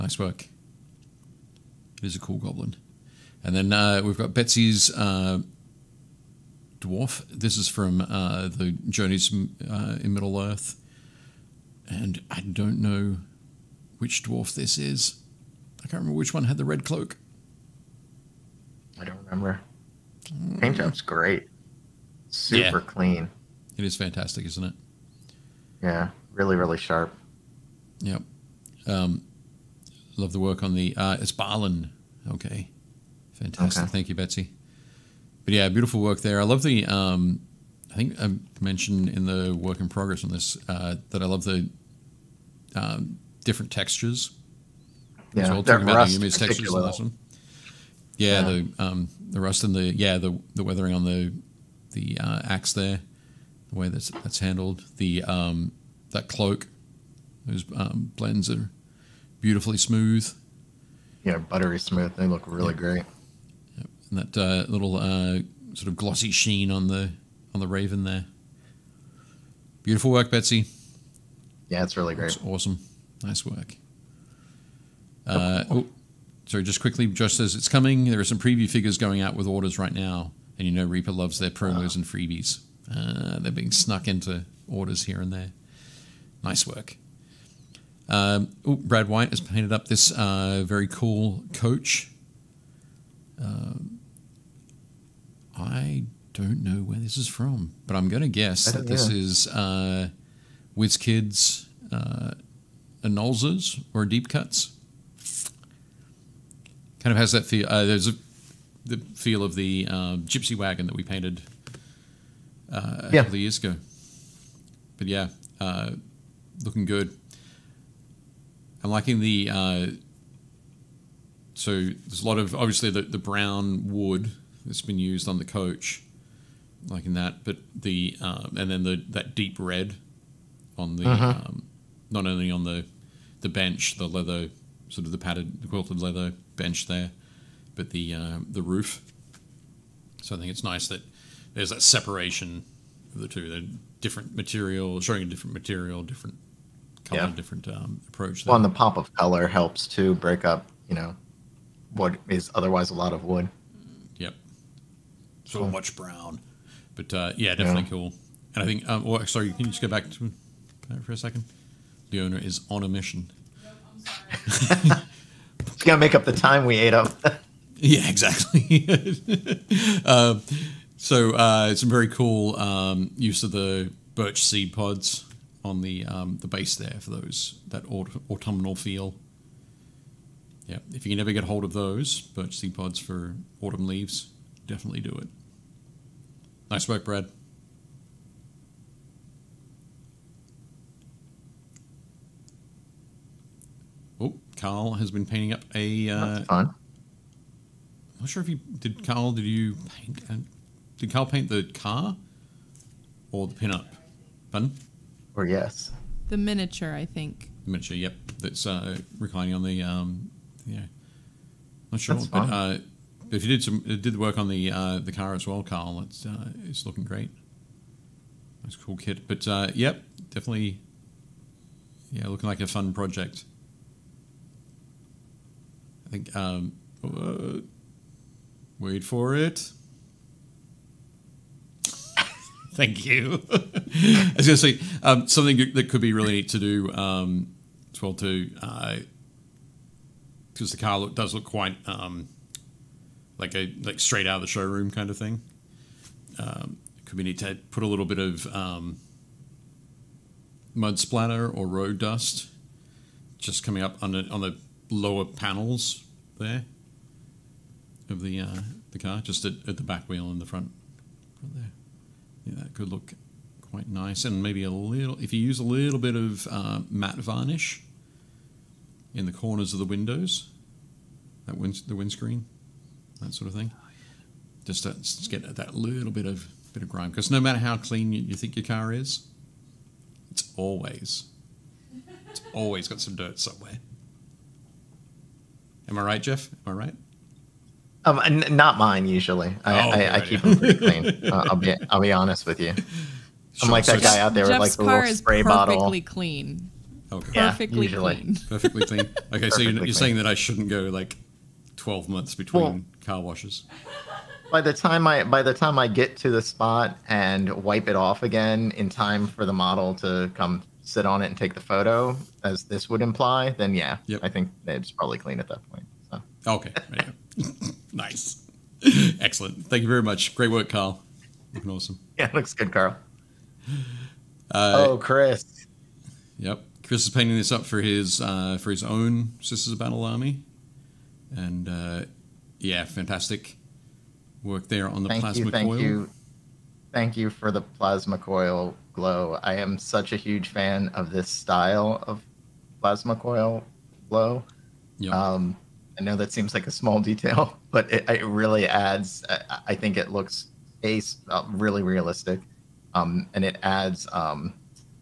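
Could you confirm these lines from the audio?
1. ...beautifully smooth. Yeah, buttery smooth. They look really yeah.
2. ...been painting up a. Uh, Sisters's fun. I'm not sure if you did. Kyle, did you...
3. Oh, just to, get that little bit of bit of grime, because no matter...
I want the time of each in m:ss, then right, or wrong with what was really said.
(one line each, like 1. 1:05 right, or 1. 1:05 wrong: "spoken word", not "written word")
1. 0:59 right
2. 3:15 wrong: "That", not "Sisters"
3. 4:33 right.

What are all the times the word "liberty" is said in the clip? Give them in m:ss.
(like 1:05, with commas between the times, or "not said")
not said.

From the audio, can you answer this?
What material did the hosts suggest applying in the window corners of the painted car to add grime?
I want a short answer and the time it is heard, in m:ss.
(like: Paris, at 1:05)
matte varnish, at 4:26.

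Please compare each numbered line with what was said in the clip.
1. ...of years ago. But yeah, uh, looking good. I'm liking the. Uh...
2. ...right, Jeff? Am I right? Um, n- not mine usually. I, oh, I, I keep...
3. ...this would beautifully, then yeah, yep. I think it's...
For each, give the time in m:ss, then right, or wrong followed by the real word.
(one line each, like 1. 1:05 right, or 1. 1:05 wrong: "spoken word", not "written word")
1. 1:53 right
2. 4:46 right
3. 5:12 wrong: "imply", not "beautifully".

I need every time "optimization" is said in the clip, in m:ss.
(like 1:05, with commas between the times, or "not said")
not said.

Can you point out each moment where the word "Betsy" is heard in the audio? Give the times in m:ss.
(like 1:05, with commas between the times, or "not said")
0:04, 0:34, 1:10.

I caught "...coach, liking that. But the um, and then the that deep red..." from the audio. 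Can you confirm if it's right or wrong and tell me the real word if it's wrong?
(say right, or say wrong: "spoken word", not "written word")
right.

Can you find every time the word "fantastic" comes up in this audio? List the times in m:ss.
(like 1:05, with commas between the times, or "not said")
0:23, 0:33, 5:32.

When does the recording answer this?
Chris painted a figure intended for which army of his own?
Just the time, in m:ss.
5:29.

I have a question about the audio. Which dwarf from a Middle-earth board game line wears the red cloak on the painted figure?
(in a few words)
Barlin.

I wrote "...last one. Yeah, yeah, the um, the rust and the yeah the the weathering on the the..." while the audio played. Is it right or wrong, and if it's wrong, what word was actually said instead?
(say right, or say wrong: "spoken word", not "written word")
right.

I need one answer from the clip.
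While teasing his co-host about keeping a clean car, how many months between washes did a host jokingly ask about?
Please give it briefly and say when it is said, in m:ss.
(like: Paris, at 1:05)
12, at 5:01.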